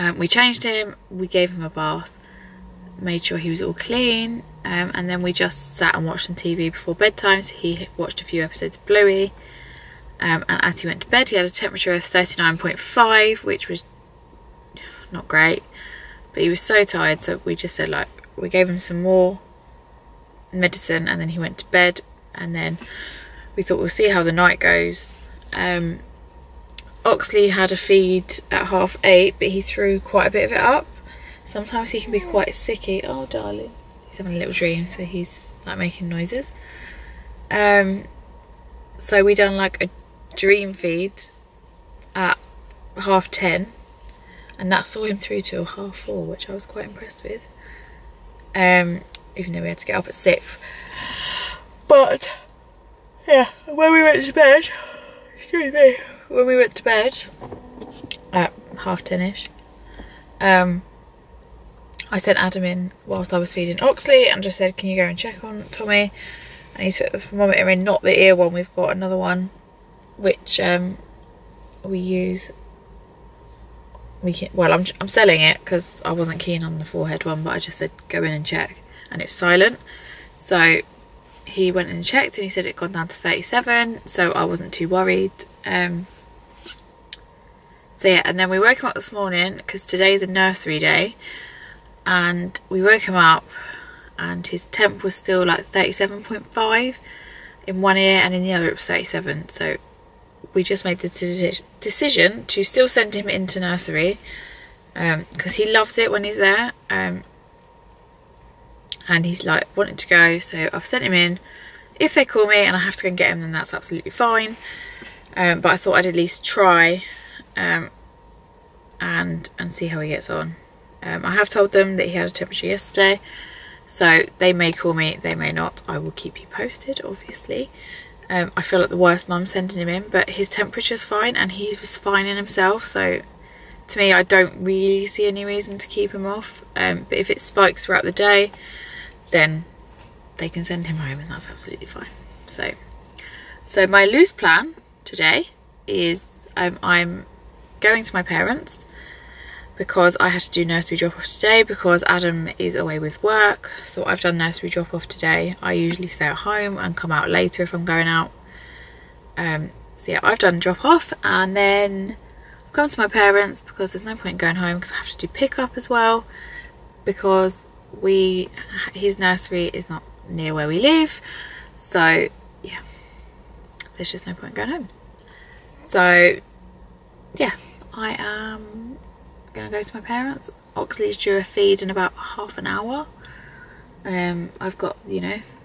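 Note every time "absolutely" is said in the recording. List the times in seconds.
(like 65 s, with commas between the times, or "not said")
113 s, 141 s.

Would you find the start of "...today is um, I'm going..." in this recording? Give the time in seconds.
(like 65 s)
145 s.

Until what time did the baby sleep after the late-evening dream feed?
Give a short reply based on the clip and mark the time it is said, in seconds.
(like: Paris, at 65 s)
half four, at 45 s.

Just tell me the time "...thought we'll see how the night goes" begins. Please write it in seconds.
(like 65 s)
23 s.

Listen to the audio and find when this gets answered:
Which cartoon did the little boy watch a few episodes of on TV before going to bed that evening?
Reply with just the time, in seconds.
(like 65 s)
8 s.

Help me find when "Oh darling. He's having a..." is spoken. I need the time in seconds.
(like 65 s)
33 s.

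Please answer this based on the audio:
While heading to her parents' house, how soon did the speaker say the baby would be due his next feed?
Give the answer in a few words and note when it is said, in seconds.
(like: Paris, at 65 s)
half an hour, at 182 s.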